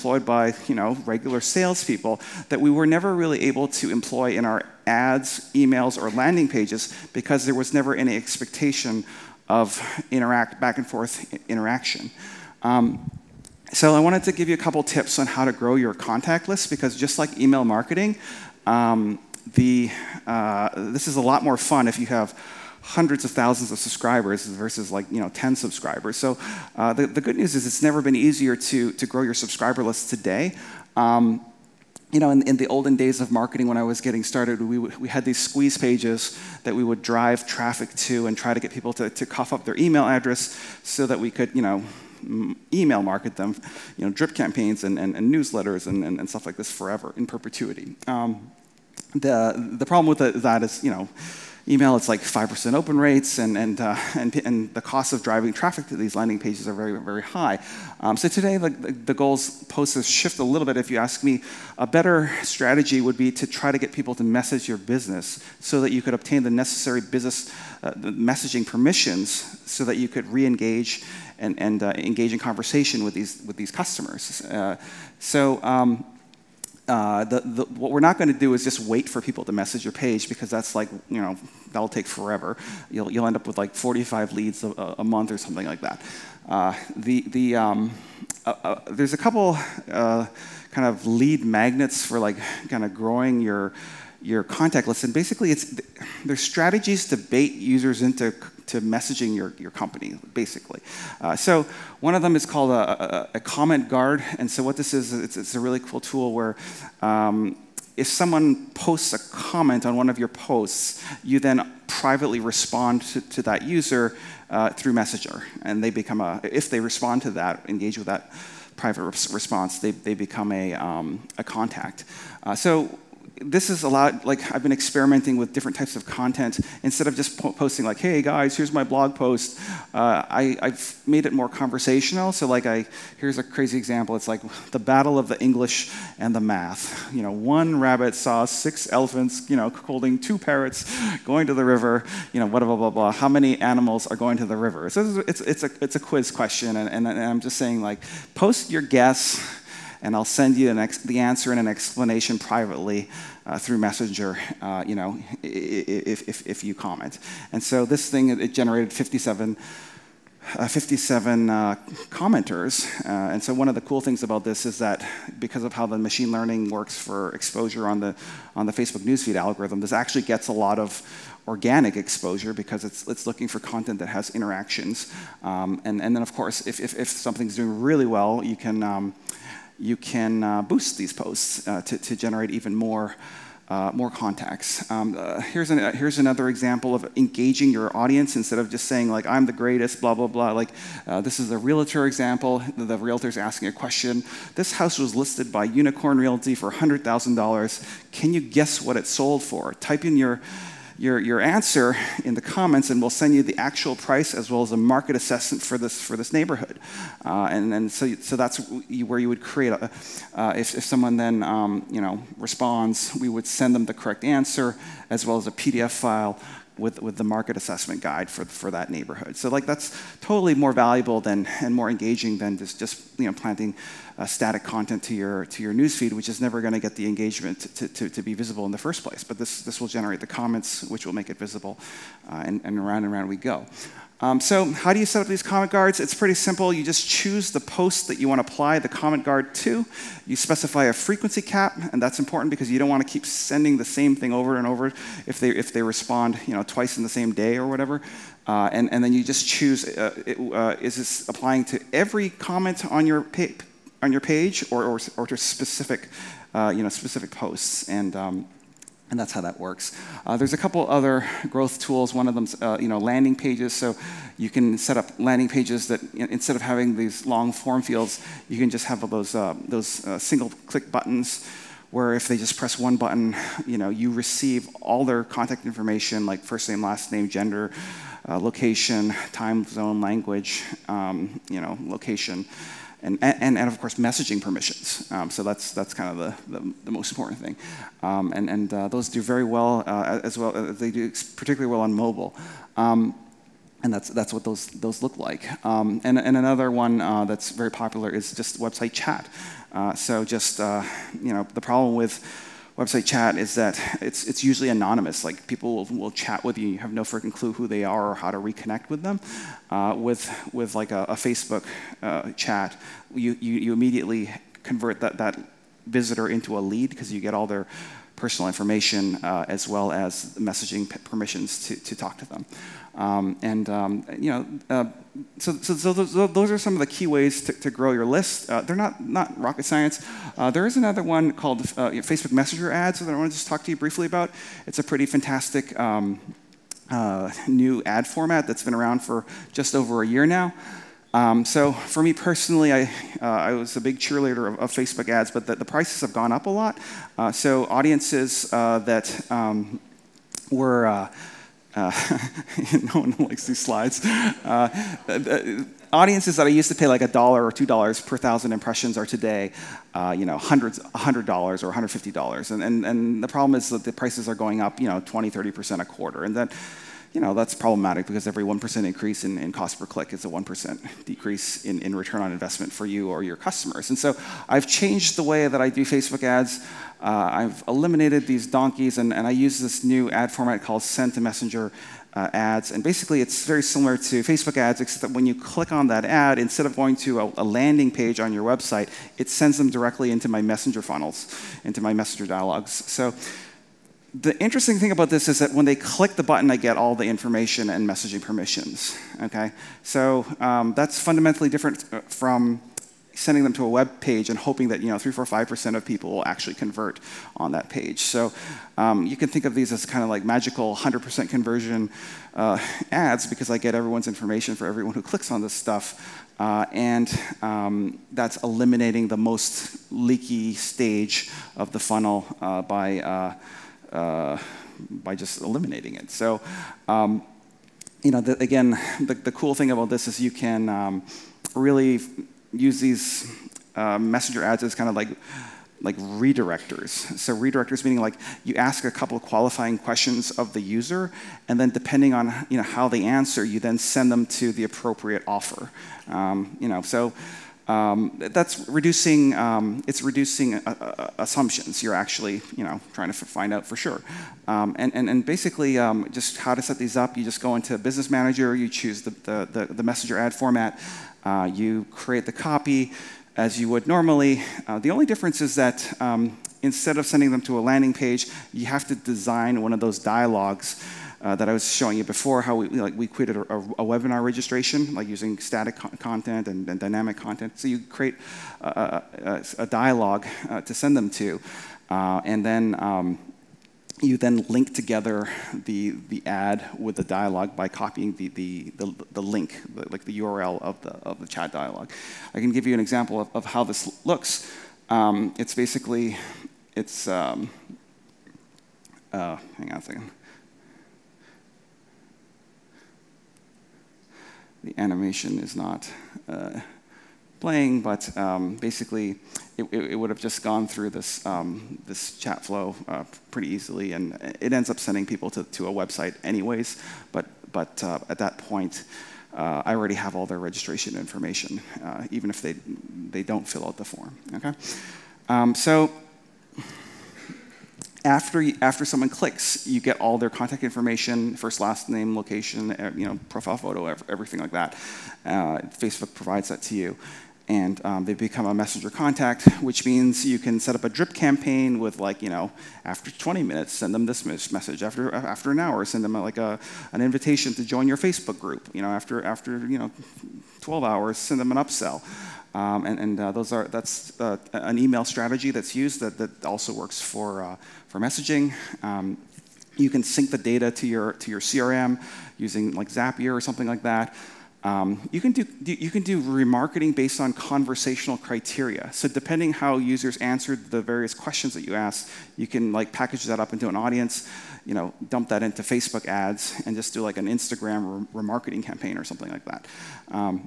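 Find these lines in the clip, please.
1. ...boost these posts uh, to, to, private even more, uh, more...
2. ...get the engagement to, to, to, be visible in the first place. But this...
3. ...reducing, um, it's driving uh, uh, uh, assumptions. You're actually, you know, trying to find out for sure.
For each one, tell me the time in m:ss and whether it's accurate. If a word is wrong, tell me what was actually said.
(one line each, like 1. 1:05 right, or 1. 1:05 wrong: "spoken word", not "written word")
1. 3:00 wrong: "generate", not "private"
2. 3:46 right
3. 7:28 wrong: "reducing", not "driving".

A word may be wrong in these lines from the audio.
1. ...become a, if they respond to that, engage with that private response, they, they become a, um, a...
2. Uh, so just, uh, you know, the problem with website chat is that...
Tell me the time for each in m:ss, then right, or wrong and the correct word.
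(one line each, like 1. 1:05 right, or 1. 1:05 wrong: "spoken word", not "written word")
1. 1:55 right
2. 4:59 right.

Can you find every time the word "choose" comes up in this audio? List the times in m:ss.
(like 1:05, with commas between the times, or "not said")
3:57, 4:09, 7:38.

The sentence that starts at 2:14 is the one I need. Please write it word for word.
It's like the battle of the English and the math.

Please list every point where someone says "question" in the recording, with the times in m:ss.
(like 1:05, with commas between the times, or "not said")
2:26, 3:13, 7:19, 9:31.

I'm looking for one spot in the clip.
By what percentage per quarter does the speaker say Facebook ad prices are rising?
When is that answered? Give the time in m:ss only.
6:04.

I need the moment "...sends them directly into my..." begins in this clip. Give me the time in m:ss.
6:29.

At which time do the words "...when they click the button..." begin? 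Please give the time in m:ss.
6:35.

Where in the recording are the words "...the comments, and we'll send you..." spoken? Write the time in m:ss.
3:22.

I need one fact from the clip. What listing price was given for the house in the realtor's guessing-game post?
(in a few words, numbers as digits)
$100,000.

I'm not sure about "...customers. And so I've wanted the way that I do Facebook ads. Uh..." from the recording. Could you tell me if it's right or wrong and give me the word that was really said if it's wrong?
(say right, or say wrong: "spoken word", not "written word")
wrong: "changed", not "wanted".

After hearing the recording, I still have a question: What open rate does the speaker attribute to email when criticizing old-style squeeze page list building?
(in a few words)
5%.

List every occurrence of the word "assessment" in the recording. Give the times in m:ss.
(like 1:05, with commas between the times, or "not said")
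3:25, 3:37.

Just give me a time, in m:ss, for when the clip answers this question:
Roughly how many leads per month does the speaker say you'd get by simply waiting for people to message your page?
1:23.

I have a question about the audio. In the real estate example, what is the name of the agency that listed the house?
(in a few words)
Unicorn Realty.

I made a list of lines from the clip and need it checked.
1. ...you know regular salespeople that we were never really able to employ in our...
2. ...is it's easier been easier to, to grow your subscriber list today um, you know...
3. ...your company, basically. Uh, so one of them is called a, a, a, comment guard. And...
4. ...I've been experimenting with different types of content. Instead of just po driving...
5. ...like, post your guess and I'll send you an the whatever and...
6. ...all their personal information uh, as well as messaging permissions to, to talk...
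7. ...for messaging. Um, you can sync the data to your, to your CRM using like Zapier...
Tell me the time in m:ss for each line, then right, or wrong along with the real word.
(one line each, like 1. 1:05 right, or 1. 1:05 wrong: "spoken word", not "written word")
1. 0:00 right
2. 0:27 wrong: "never", not "easier"
3. 1:39 right
4. 2:04 wrong: "posting", not "driving"
5. 2:27 wrong: "answer", not "whatever"
6. 5:17 right
7. 9:17 right.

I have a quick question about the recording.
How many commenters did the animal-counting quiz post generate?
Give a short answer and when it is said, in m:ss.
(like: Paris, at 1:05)
57, at 2:40.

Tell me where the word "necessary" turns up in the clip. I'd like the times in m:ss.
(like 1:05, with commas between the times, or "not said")
1:06.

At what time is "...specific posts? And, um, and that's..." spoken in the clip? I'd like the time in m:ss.
4:16.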